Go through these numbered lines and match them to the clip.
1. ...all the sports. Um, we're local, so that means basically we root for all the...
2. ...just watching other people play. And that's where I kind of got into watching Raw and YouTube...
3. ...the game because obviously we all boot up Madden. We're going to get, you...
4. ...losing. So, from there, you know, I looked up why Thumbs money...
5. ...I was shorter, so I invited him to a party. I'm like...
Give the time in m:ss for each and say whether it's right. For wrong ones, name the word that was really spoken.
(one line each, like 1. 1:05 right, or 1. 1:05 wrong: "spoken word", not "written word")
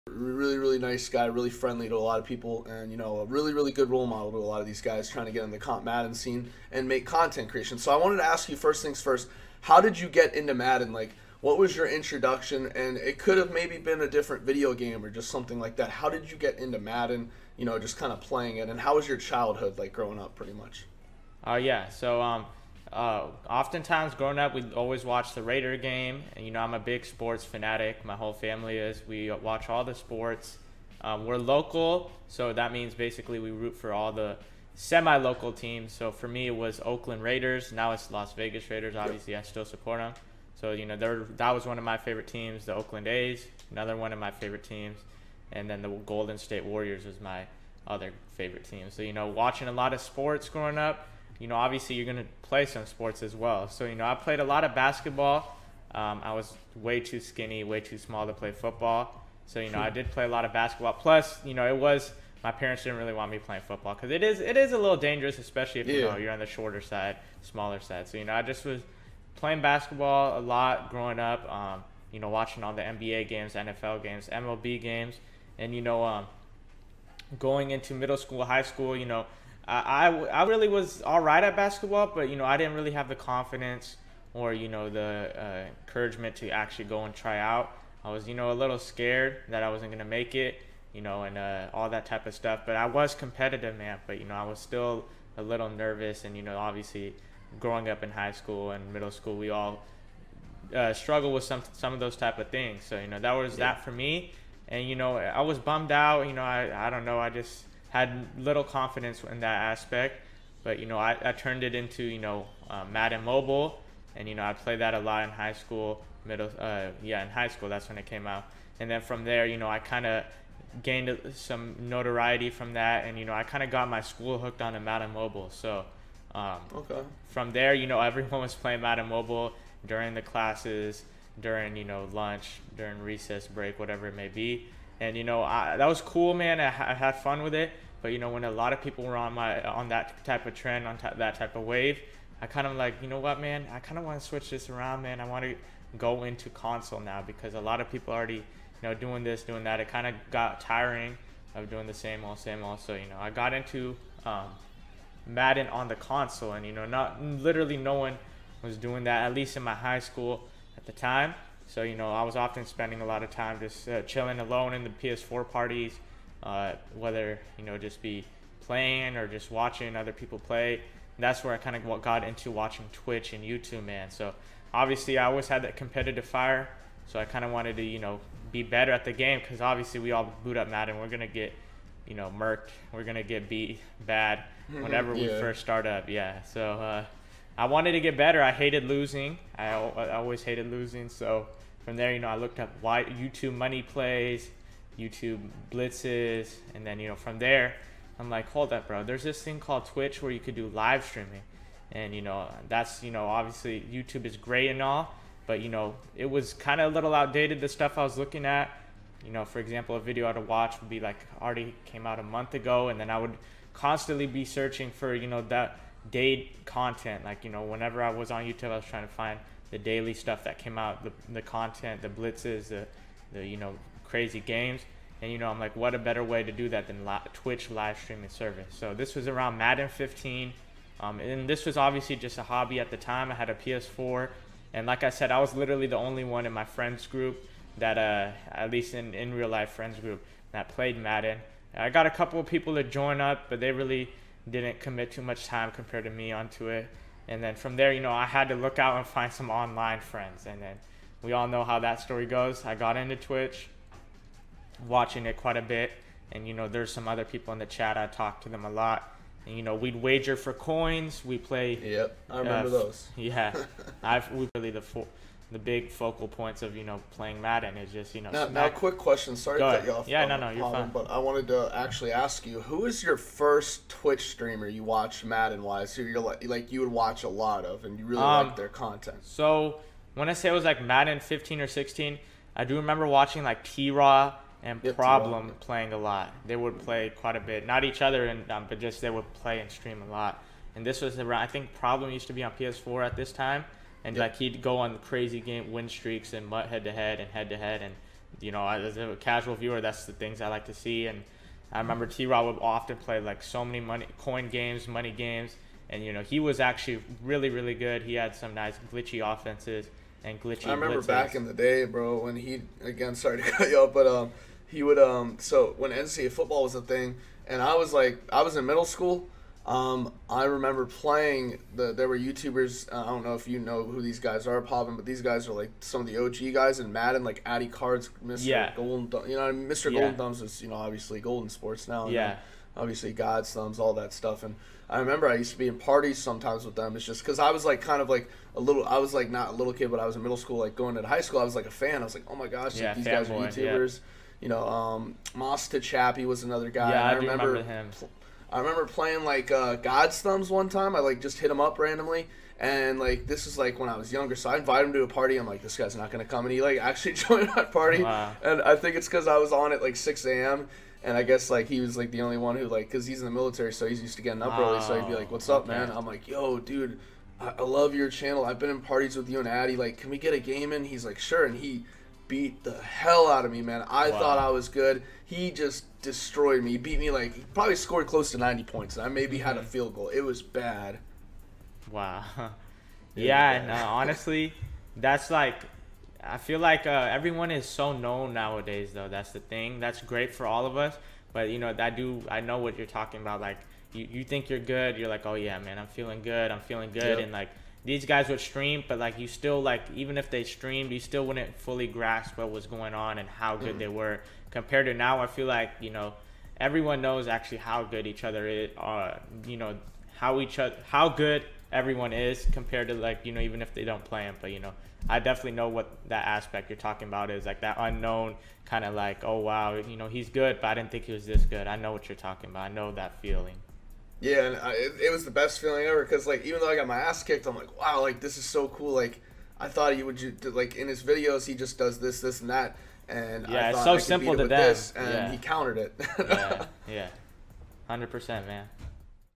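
1. 0:29 right
2. 2:49 wrong: "Twitch", not "Raw"
3. 2:59 right
4. 3:10 wrong: "YouTube", not "Thumbs"
5. 5:53 wrong: "younger", not "shorter".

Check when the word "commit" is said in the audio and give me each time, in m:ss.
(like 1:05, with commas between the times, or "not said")
4:04.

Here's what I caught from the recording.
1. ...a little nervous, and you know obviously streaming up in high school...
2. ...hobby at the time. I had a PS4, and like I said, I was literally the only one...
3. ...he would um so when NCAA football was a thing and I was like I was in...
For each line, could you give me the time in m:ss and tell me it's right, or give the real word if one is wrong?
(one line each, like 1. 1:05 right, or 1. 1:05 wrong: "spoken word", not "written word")
1. 1:35 wrong: "growing", not "streaming"
2. 3:52 right
3. 5:14 right.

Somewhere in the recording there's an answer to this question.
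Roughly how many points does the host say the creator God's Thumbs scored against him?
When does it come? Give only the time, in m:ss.
6:18.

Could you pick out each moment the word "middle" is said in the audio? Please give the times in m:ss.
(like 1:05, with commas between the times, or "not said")
1:17, 1:38, 1:56, 5:18, 5:40.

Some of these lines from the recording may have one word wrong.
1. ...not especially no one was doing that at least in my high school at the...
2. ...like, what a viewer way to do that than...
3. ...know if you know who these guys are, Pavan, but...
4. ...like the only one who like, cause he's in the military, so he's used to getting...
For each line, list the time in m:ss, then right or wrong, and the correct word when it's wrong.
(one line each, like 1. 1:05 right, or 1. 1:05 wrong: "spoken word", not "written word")
1. 2:36 wrong: "literally", not "especially"
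2. 3:45 wrong: "better", not "viewer"
3. 5:23 right
4. 6:01 right.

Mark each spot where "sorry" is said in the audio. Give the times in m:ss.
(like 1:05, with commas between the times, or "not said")
4:29, 5:13.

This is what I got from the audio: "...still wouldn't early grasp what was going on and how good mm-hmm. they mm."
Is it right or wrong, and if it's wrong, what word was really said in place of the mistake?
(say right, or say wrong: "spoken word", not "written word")
wrong: "fully", not "early".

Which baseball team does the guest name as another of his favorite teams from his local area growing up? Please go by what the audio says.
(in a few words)
Oakland A's.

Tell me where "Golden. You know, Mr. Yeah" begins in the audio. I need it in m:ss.
5:28.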